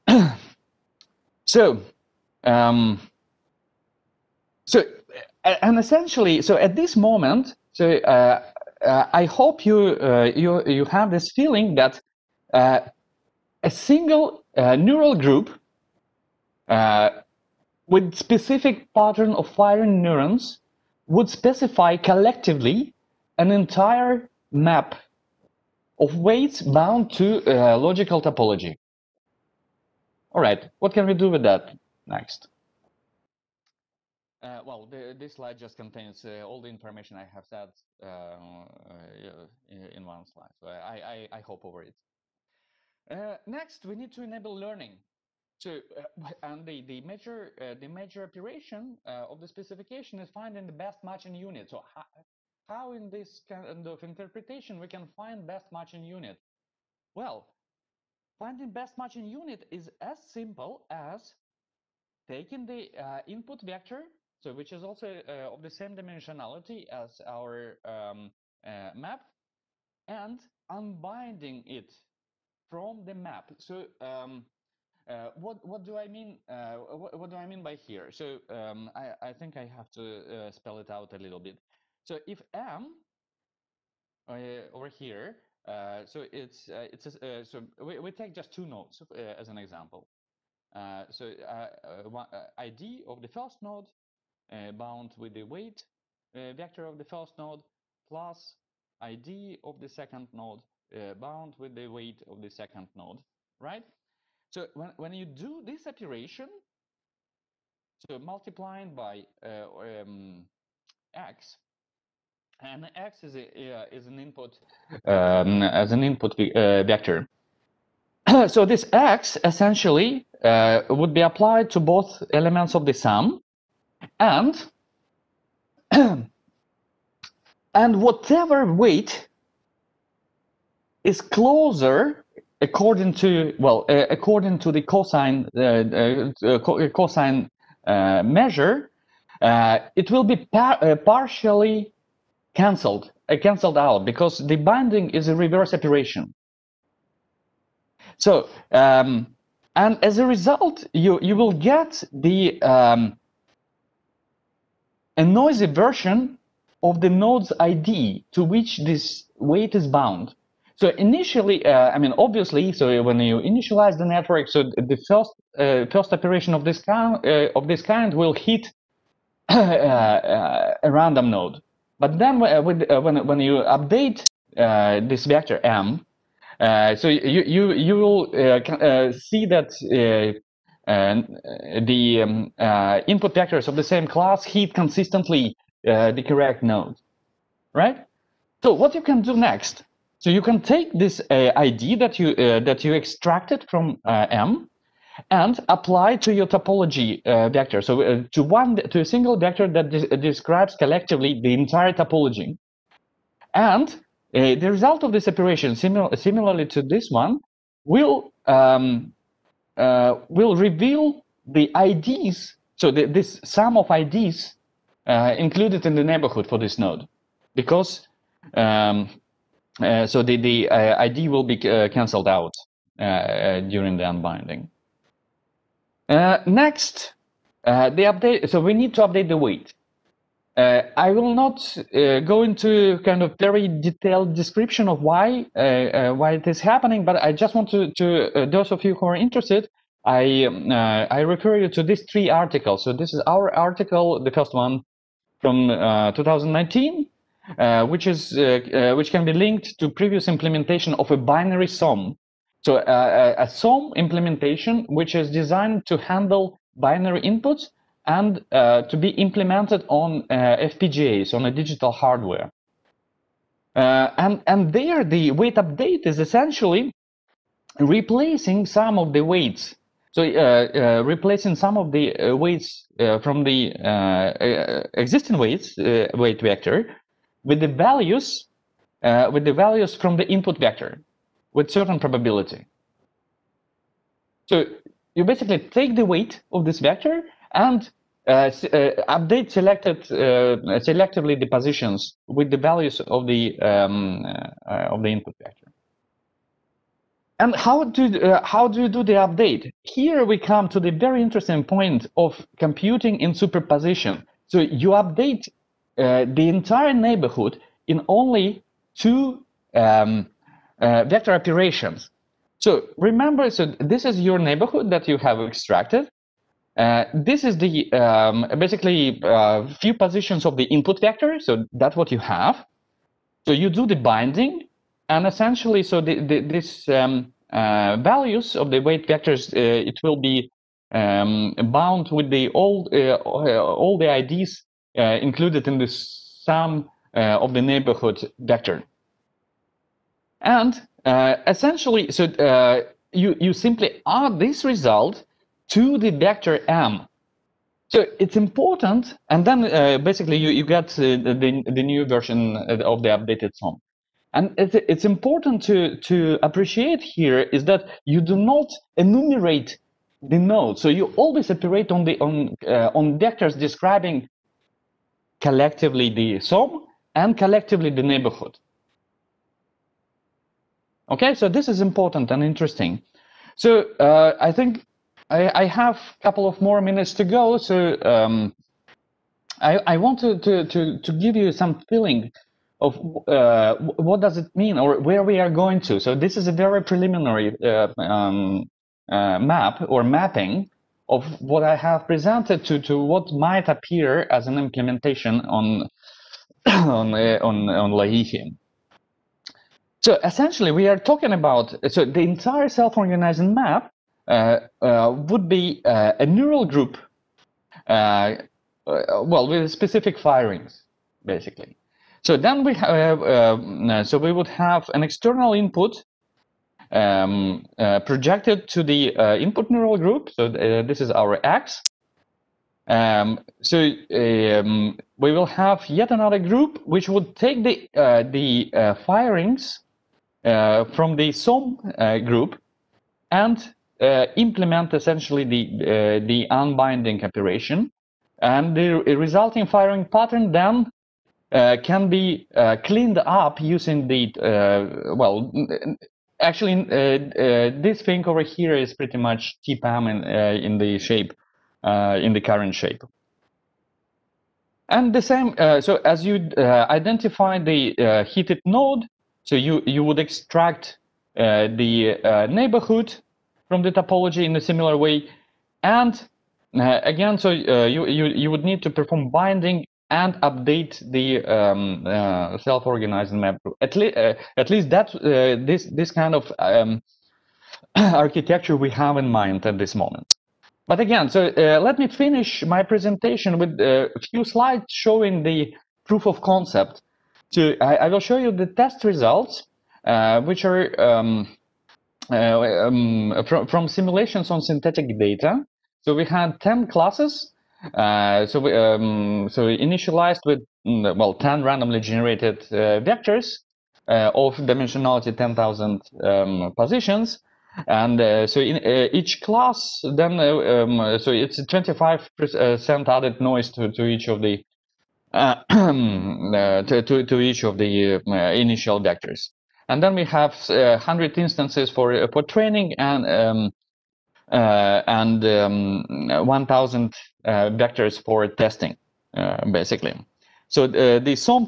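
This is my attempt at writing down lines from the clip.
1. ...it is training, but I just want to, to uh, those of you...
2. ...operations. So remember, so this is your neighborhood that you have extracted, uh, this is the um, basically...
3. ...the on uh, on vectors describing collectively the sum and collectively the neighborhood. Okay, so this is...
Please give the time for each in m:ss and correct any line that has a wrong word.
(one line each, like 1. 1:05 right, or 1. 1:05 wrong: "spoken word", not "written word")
1. 3:56 wrong: "happening", not "training"
2. 5:11 right
3. 6:02 right.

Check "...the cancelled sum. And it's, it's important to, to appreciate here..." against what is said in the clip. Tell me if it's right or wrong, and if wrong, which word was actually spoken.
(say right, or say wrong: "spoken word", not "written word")
wrong: "updated", not "cancelled".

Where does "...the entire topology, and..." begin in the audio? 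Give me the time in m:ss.
3:21.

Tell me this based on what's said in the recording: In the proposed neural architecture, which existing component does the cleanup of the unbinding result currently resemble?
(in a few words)
TPAM.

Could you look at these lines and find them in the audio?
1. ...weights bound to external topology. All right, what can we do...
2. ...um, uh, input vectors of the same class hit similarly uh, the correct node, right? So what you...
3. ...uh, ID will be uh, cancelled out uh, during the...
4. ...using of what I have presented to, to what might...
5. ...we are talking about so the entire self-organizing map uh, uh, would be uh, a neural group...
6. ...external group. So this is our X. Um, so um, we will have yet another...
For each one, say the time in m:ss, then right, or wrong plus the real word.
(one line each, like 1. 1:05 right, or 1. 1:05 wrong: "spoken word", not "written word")
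1. 0:26 wrong: "logical", not "external"
2. 3:02 wrong: "consistently", not "similarly"
3. 3:40 right
4. 6:30 wrong: "mapping", not "using"
5. 6:40 right
6. 6:59 wrong: "neural", not "external".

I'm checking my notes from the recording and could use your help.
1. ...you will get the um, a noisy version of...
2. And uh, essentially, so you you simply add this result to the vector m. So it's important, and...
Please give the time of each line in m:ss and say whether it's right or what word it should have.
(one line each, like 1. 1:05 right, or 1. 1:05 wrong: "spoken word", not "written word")
1. 2:31 right
2. 5:40 right.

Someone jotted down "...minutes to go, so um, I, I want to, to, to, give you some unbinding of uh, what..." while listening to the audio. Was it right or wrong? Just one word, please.
wrong.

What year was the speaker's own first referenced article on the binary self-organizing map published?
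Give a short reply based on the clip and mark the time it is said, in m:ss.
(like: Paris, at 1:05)
2019, at 4:06.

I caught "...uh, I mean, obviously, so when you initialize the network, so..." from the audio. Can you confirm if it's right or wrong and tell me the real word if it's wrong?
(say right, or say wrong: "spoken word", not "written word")
right.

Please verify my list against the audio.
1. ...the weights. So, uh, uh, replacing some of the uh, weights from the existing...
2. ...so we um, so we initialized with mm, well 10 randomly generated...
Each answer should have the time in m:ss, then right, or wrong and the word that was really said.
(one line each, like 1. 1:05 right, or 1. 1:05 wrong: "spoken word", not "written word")
1. 4:29 right
2. 8:18 right.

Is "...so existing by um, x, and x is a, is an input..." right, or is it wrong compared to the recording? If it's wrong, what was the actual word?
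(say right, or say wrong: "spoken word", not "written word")
wrong: "multiplying", not "existing".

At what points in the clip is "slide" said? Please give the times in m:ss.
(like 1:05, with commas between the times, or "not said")
0:35, 0:40, 8:04.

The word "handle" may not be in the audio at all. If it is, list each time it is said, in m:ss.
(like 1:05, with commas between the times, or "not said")
4:15.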